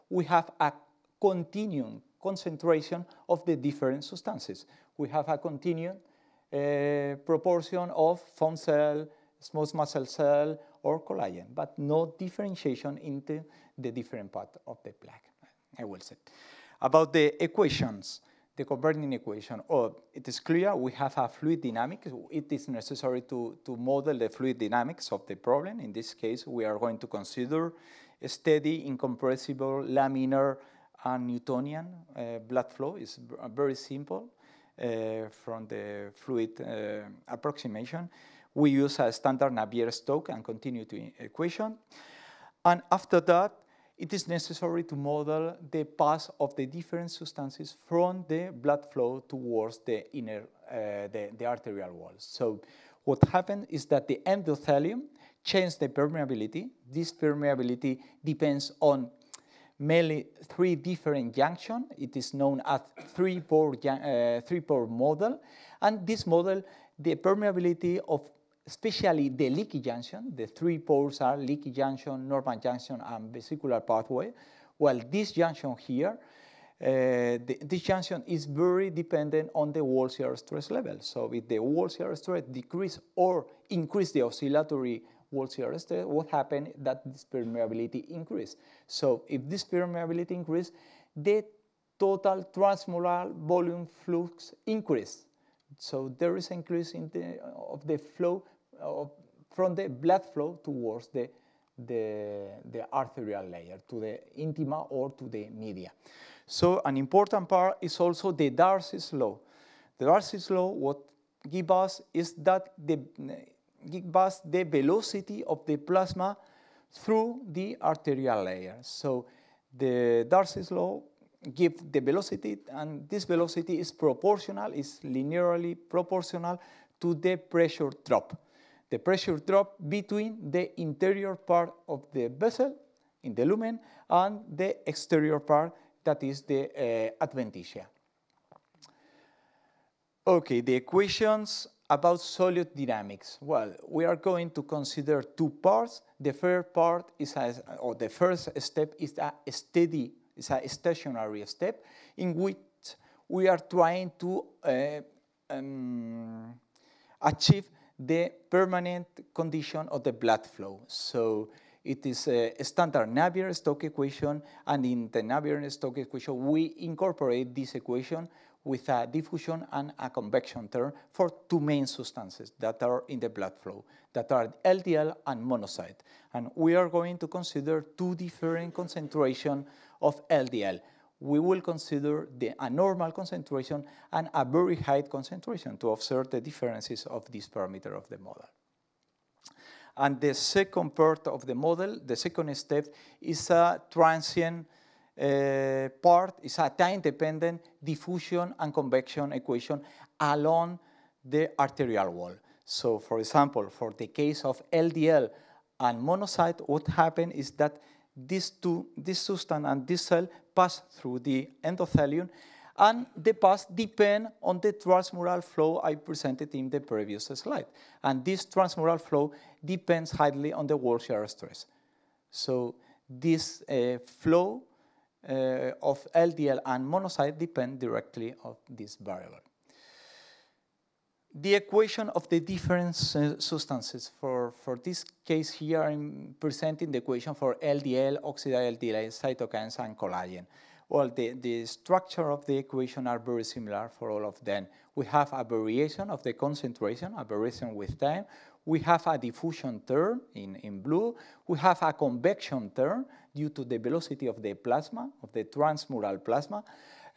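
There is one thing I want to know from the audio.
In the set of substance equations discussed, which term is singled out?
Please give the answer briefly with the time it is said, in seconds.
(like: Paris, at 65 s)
Diffusion term, at 249 s.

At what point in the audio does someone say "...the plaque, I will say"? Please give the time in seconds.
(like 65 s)
14 s.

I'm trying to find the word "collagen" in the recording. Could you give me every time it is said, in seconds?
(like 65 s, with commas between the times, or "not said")
11 s, 239 s.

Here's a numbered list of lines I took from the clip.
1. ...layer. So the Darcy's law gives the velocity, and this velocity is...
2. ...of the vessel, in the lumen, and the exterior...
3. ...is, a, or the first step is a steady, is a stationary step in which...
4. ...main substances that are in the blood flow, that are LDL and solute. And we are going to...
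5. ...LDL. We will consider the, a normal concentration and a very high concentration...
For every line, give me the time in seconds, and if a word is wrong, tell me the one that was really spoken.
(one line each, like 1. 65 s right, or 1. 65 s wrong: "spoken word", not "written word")
1. 118 s right
2. 131 s right
3. 147 s right
4. 171 s wrong: "monocyte", not "solute"
5. 180 s right.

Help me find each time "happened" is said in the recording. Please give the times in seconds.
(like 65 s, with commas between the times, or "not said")
53 s, 86 s, 206 s.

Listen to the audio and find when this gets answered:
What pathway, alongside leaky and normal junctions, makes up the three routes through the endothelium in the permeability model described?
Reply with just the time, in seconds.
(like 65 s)
73 s.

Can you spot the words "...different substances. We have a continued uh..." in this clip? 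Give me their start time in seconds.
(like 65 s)
3 s.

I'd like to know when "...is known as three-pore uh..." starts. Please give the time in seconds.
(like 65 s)
62 s.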